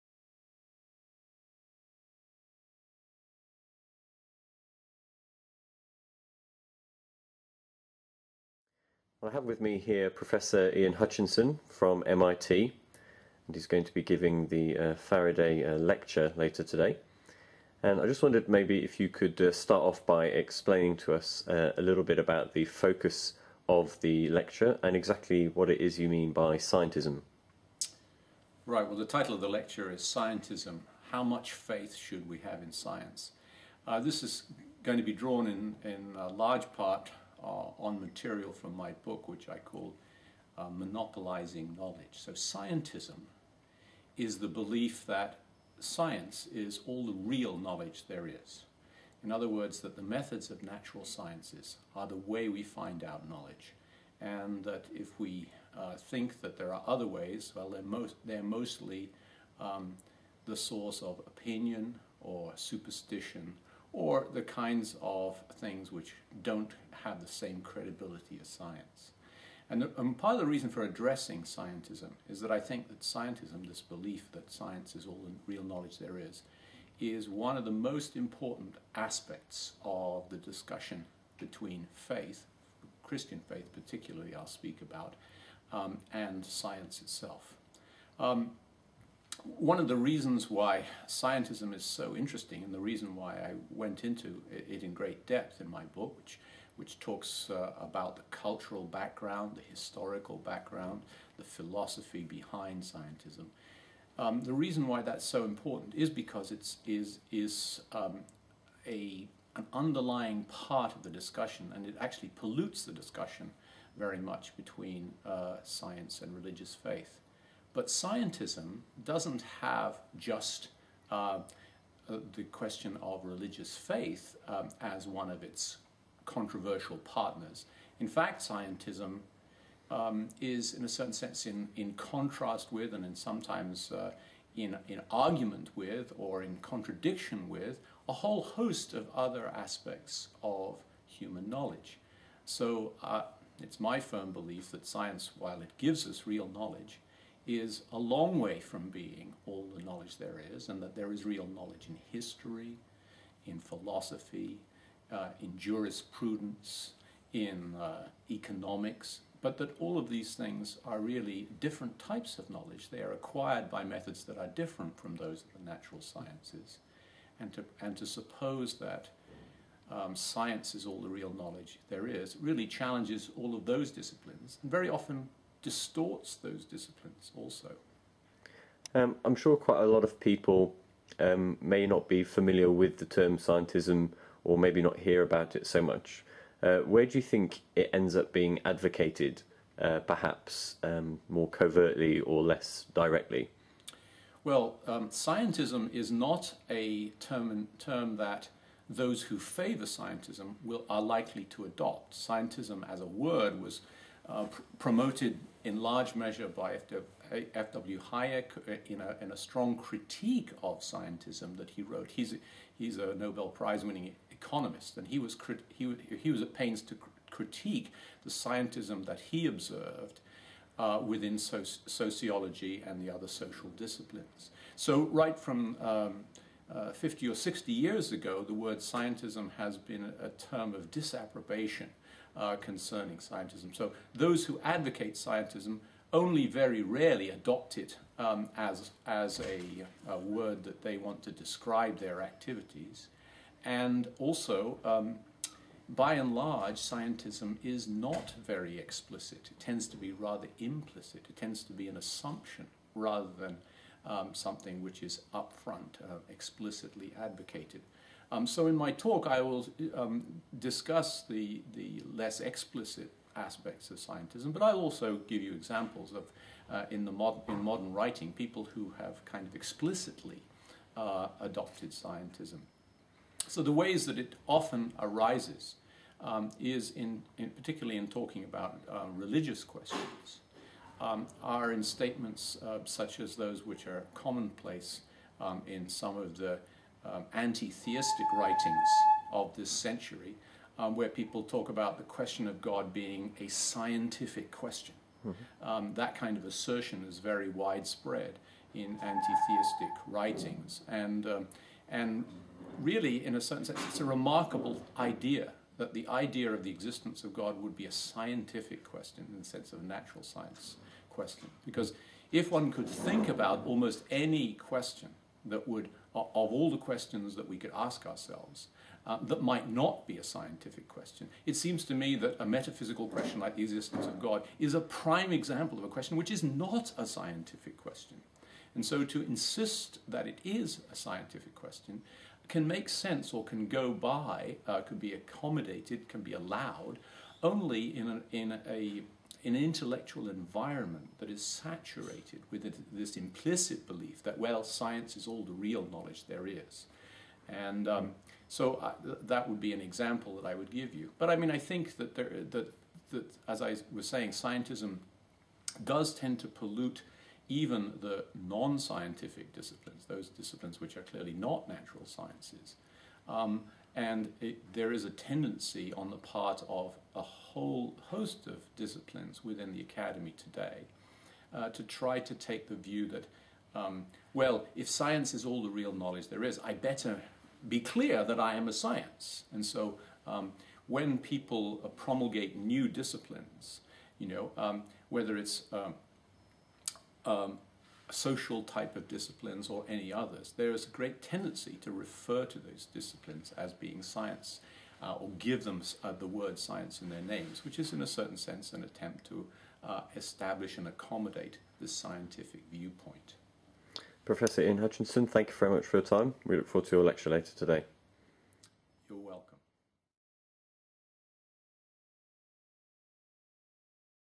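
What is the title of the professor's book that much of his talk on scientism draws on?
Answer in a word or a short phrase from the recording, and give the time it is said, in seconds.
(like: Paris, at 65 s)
Monopolizing Knowledge, at 40 s.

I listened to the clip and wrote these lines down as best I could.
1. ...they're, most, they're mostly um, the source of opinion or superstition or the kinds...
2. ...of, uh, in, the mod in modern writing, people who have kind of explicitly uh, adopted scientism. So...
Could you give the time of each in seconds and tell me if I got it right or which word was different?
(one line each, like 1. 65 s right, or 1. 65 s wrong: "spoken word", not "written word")
1. 57 s right
2. 266 s right.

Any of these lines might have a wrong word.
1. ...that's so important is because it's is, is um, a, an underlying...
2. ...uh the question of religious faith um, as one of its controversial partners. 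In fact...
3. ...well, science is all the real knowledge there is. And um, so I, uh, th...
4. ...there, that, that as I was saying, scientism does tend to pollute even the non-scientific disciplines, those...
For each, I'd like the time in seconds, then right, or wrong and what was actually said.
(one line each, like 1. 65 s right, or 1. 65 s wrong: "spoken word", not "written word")
1. 105 s right
2. 122 s right
3. 344 s right
4. 352 s right.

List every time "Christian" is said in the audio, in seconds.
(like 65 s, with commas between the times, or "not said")
83 s.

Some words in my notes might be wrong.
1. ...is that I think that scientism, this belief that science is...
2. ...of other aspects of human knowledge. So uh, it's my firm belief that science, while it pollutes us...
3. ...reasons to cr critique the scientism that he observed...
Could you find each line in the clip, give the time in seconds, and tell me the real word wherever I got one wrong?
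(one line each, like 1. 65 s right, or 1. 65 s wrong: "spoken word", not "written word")
1. 72 s right
2. 138 s wrong: "gives", not "pollutes"
3. 216 s wrong: "pains", not "reasons".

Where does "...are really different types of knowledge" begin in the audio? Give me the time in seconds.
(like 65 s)
160 s.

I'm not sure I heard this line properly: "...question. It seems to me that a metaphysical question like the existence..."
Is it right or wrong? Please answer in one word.
right.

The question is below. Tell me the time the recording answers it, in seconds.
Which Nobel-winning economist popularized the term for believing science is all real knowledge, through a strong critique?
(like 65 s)
207 s.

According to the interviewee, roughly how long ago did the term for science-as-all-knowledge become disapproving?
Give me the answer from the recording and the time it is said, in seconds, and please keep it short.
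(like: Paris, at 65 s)
50 or 60 years, at 226 s.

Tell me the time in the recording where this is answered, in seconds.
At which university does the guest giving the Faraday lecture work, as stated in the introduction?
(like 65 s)
12 s.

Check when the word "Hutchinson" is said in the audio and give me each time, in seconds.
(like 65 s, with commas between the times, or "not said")
10 s, 404 s.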